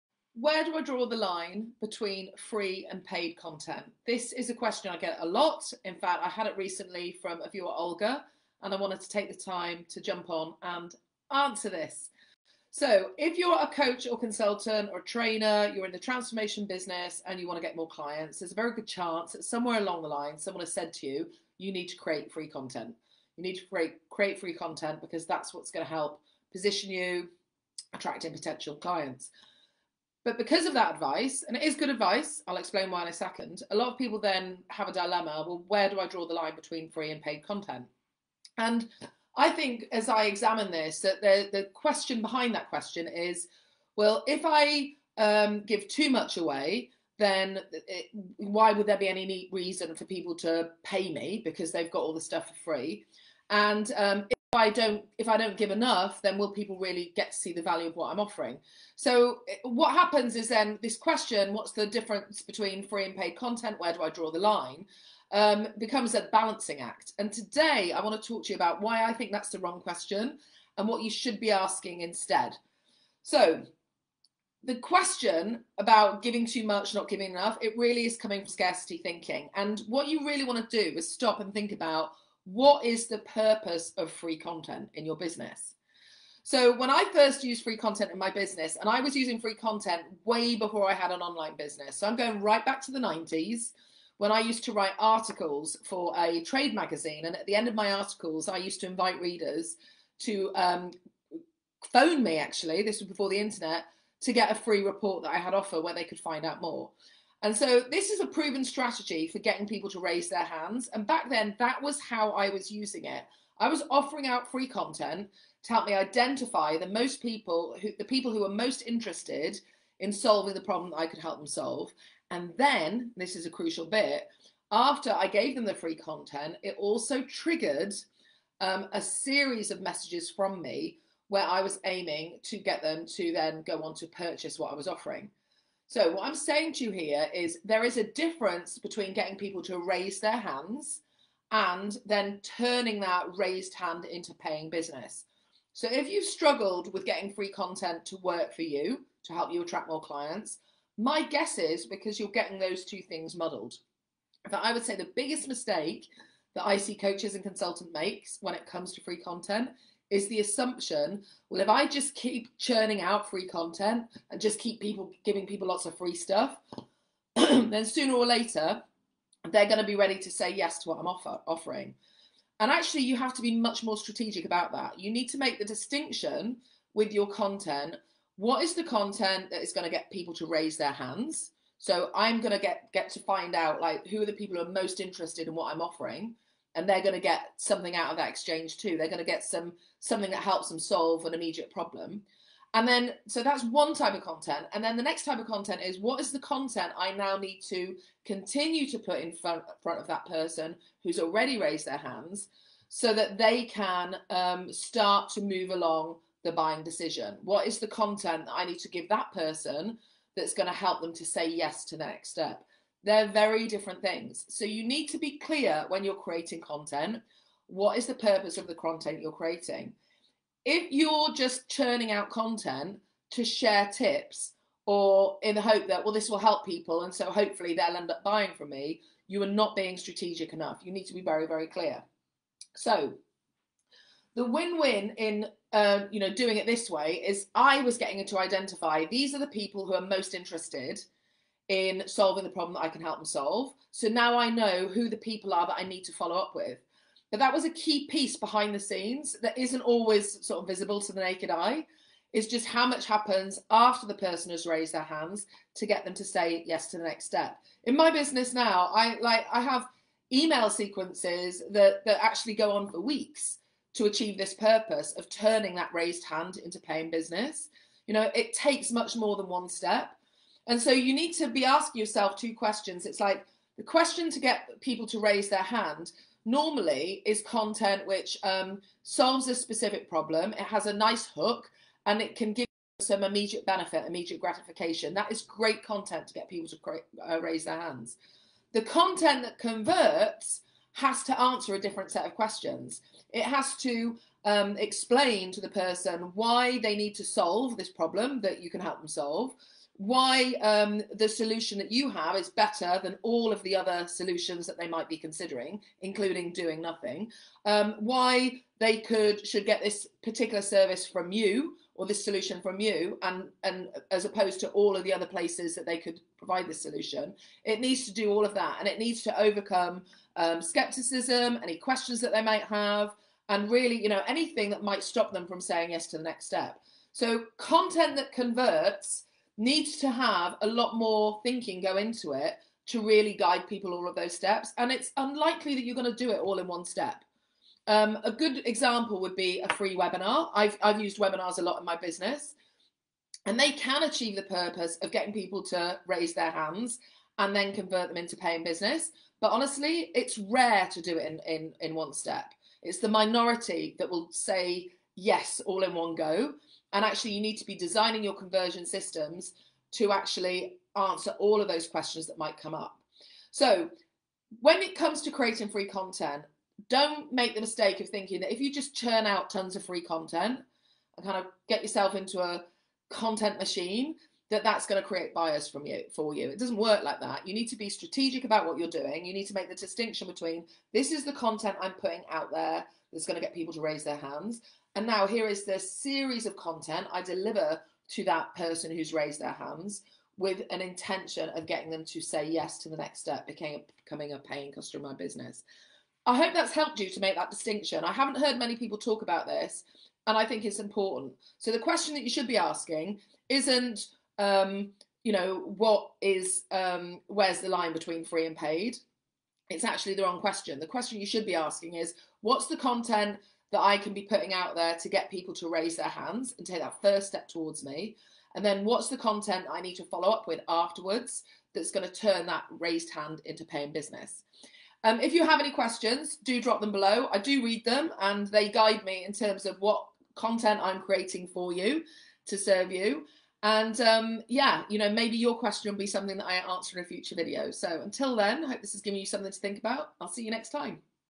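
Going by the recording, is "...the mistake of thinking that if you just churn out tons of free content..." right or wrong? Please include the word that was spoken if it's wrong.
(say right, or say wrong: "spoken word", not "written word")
right.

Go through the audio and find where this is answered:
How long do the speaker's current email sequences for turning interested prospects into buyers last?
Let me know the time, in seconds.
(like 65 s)
262 s.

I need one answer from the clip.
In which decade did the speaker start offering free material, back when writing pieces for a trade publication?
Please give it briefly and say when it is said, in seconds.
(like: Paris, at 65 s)
1990s, at 92 s.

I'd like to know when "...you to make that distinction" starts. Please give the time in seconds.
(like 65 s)
396 s.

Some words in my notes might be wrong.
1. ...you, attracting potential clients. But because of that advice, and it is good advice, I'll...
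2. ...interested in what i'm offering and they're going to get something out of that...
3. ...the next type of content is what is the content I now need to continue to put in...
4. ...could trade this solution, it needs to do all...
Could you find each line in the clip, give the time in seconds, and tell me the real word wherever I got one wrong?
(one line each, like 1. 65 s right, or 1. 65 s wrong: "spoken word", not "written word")
1. 26 s right
2. 184 s right
3. 194 s right
4. 315 s wrong: "provide", not "trade".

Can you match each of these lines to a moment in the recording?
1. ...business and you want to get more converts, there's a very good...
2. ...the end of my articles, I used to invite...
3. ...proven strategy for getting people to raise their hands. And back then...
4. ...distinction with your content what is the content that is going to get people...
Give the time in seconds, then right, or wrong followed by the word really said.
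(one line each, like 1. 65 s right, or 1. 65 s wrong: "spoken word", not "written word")
1. 16 s wrong: "clients", not "converts"
2. 97 s right
3. 108 s right
4. 175 s right.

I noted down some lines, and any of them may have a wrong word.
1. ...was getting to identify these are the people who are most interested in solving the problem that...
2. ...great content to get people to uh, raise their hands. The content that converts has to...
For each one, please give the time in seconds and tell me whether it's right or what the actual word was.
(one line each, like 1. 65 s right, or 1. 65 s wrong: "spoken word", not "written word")
1. 237 s right
2. 285 s right.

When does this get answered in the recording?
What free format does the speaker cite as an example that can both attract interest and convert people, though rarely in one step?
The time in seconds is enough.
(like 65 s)
339 s.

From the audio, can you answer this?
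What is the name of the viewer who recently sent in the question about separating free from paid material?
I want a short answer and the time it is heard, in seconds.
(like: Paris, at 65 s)
Olga, at 7 s.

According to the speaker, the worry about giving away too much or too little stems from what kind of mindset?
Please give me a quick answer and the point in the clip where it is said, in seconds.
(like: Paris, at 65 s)
Scarcity thinking, at 78 s.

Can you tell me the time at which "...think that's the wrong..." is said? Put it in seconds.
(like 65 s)
69 s.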